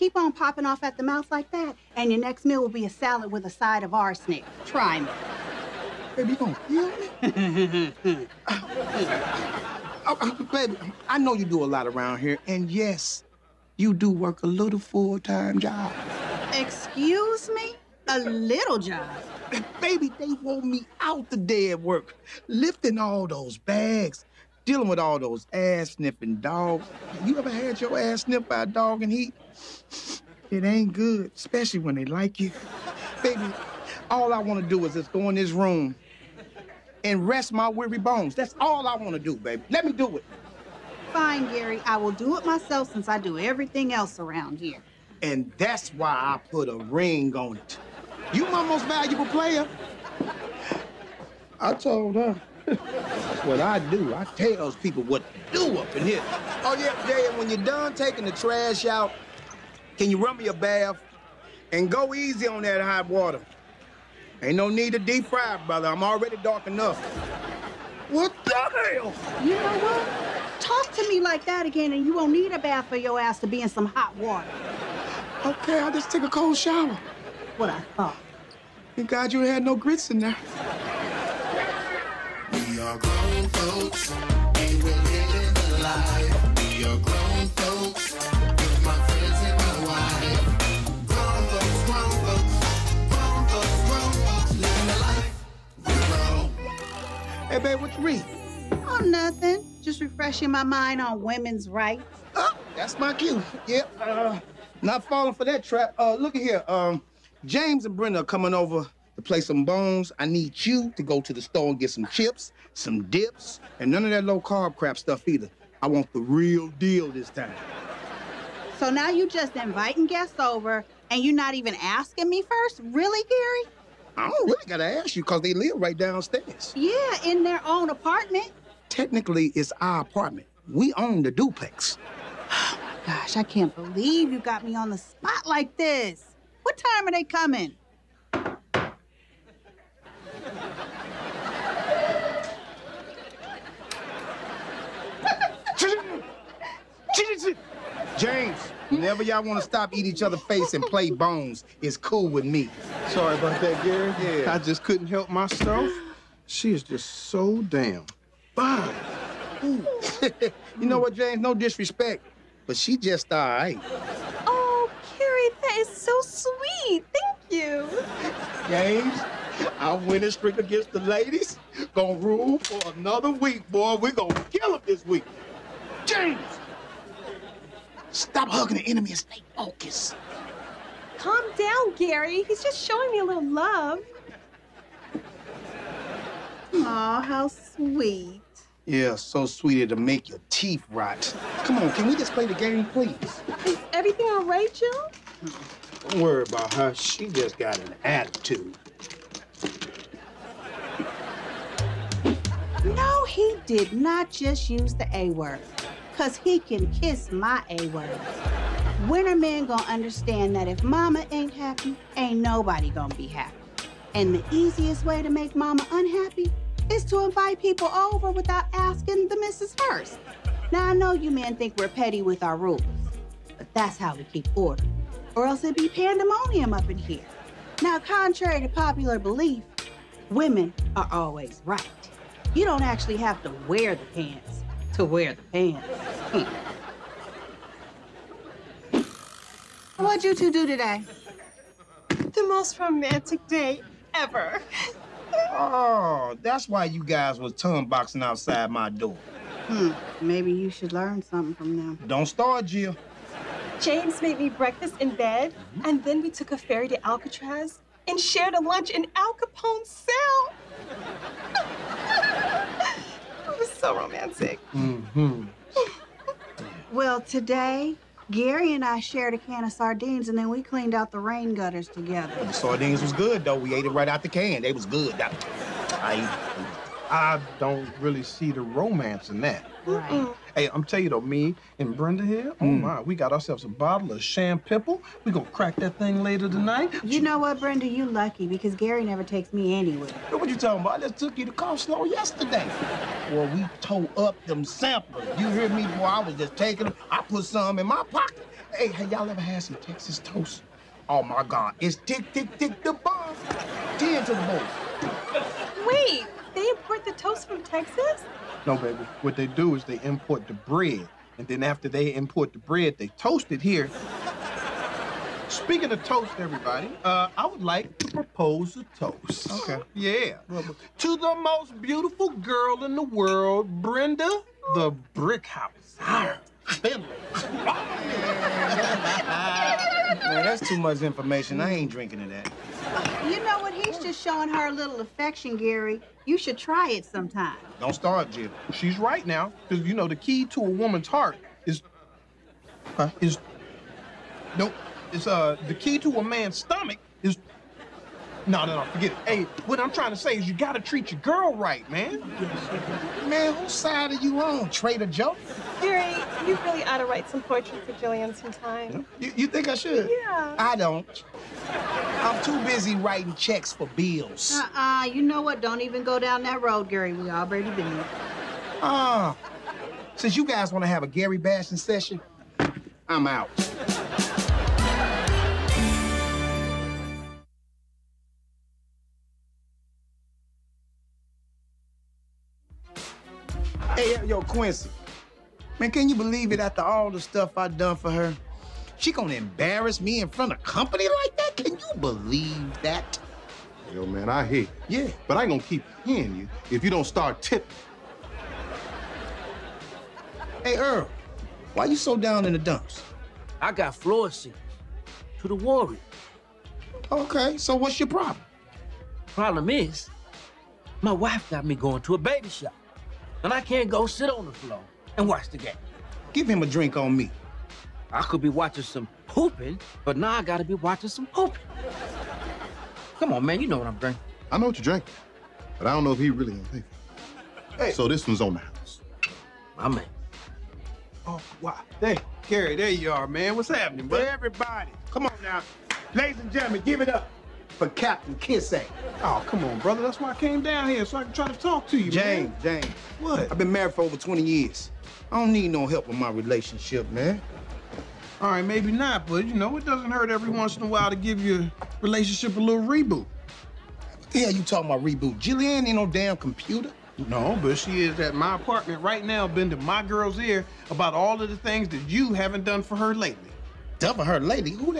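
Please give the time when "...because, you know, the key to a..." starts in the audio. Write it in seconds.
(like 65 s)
339 s.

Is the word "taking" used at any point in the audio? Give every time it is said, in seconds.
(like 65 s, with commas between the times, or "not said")
57 s, 296 s.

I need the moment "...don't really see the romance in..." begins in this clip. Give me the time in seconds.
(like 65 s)
277 s.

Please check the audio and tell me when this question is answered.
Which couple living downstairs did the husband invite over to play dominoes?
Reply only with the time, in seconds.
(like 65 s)
107 s.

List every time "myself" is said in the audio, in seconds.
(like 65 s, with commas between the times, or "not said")
42 s, 155 s.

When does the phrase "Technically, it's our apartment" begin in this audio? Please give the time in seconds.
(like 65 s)
128 s.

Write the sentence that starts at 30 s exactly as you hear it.
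It ain't good, especially when they like you.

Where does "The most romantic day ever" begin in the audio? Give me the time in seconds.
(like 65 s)
242 s.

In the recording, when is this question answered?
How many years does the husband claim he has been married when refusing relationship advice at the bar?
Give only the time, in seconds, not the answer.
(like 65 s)
444 s.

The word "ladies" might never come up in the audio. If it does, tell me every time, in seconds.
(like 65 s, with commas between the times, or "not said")
170 s, 436 s.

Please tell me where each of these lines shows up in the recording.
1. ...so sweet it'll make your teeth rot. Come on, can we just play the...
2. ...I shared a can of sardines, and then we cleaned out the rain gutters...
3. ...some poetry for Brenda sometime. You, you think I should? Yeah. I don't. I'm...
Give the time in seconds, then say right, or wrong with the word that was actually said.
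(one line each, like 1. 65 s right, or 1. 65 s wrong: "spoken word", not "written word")
1. 189 s right
2. 268 s right
3. 357 s wrong: "Jillian", not "Brenda".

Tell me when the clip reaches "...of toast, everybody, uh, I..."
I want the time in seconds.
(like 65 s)
315 s.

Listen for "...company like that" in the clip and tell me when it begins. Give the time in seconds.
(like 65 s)
390 s.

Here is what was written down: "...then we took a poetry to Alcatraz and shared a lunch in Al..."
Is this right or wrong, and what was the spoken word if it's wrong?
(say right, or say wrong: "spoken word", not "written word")
wrong: "ferry", not "poetry".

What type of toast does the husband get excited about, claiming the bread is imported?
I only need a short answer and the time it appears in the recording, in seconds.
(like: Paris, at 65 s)
Texas toast, at 299 s.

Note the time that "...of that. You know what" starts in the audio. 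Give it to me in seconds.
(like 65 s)
332 s.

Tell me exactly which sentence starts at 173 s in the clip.
we gonna kill them this week.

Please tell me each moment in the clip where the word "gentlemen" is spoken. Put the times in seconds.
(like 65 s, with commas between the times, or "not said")
436 s.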